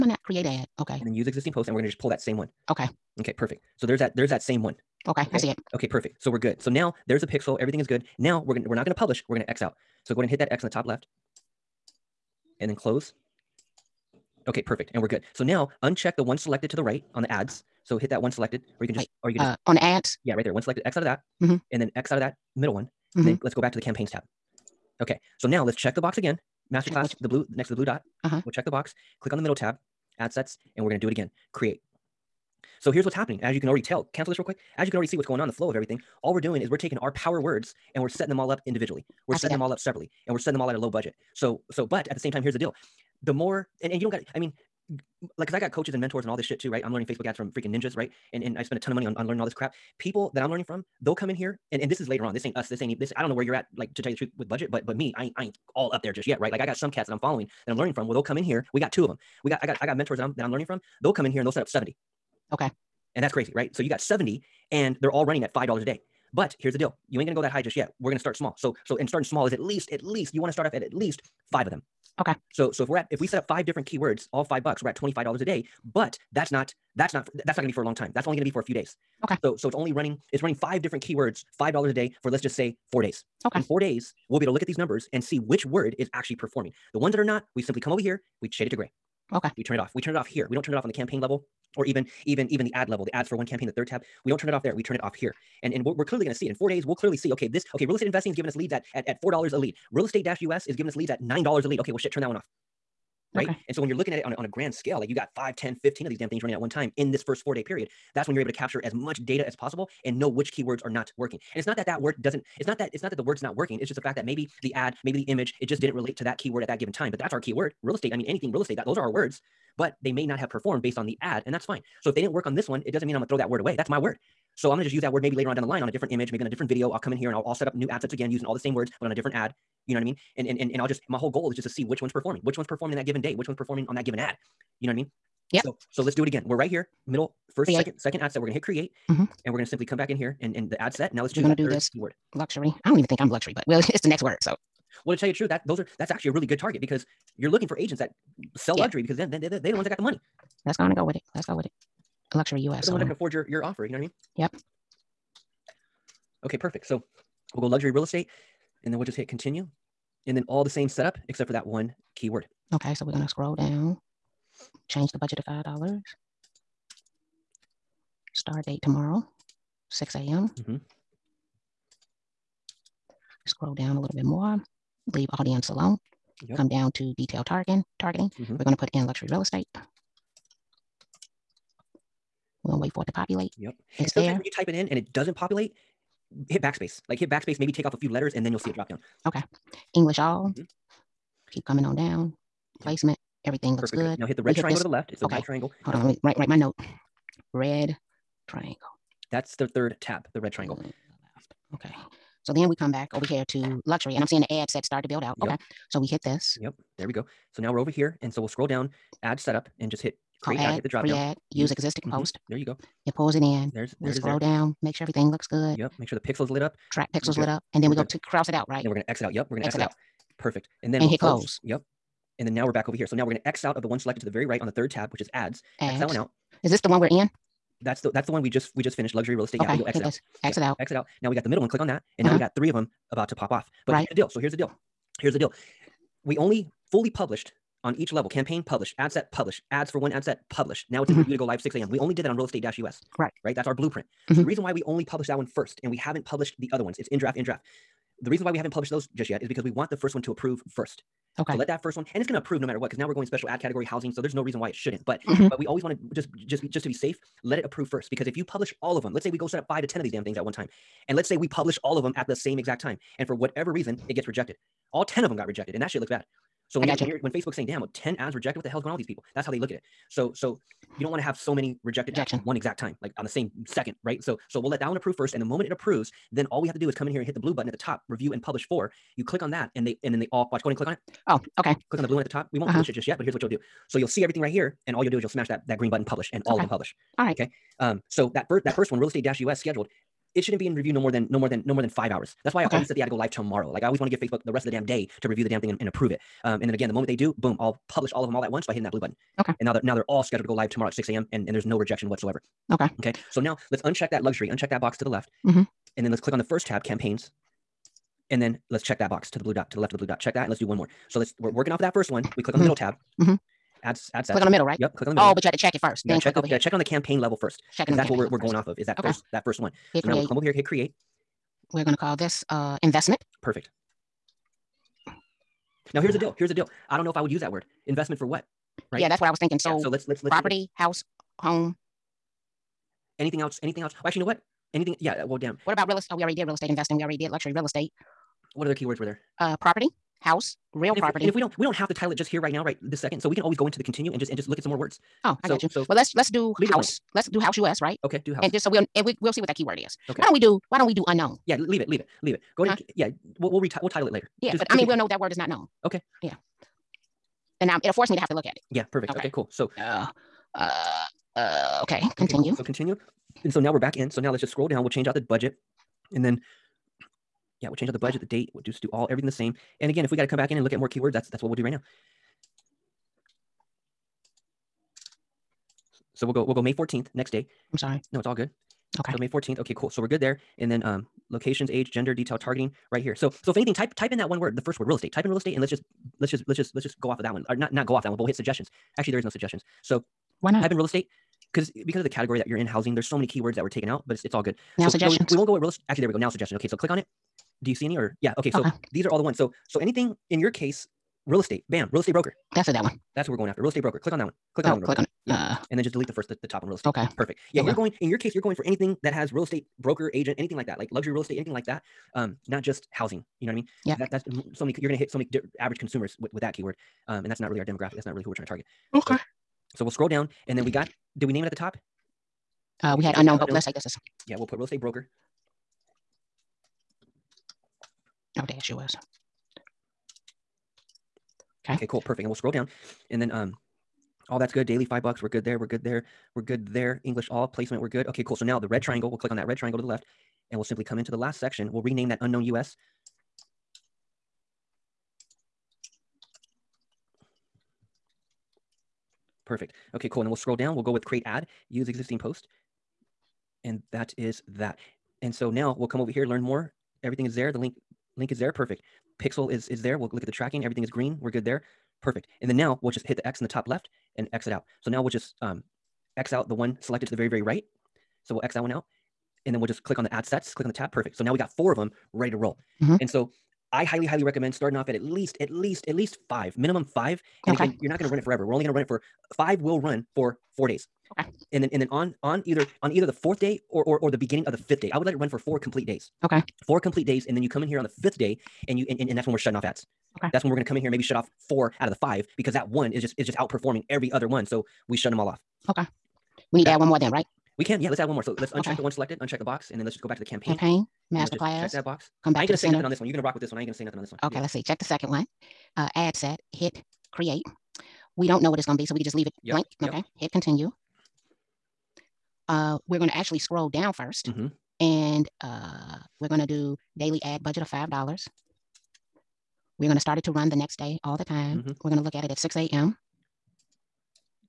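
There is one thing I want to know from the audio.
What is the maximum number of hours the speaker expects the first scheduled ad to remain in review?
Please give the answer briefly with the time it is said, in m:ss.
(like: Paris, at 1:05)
5 hours, at 4:51.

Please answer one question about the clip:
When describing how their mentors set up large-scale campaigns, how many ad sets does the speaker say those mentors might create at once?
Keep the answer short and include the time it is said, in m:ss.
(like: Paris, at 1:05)
70, at 1:01.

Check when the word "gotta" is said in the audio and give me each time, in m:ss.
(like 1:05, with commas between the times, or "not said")
5:16.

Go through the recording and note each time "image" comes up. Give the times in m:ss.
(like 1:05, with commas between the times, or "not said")
1:55, 2:06.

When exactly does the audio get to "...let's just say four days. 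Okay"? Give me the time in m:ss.
1:22.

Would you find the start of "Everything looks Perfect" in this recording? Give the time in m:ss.
3:13.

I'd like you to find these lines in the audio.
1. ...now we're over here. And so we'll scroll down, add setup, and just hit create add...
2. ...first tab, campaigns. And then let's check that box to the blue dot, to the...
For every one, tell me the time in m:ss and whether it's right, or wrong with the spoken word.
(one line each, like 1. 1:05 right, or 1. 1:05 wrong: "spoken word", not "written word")
1. 3:27 right
2. 5:06 right.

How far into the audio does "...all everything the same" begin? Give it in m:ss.
6:08.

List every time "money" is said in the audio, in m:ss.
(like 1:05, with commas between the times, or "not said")
0:48, 2:30.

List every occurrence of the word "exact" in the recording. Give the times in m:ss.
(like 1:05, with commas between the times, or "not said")
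4:22, 4:32.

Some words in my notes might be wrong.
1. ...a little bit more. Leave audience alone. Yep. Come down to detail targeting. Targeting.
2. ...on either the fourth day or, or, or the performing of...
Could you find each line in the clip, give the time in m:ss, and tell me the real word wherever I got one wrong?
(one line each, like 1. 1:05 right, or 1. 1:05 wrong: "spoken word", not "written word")
1. 2:53 right
2. 8:02 wrong: "beginning", not "performing".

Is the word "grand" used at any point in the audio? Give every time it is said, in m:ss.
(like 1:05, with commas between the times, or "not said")
1:44.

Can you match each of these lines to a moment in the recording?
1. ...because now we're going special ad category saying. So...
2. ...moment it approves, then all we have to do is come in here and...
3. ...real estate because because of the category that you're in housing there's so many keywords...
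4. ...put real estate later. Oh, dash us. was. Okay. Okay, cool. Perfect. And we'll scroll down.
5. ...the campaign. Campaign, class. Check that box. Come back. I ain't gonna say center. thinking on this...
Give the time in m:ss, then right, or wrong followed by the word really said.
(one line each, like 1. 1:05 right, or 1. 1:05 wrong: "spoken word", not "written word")
1. 4:12 wrong: "housing", not "saying"
2. 4:35 right
3. 6:30 right
4. 7:04 wrong: "broker", not "later"
5. 8:20 wrong: "nothing", not "thinking".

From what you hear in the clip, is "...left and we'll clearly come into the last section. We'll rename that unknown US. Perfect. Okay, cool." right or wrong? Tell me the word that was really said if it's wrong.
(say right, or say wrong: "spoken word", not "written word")
wrong: "simply", not "clearly".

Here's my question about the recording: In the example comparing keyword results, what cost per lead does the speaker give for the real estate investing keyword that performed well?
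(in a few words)
$4.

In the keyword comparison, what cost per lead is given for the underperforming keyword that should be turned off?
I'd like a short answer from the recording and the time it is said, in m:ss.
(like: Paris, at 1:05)
$9, at 1:41.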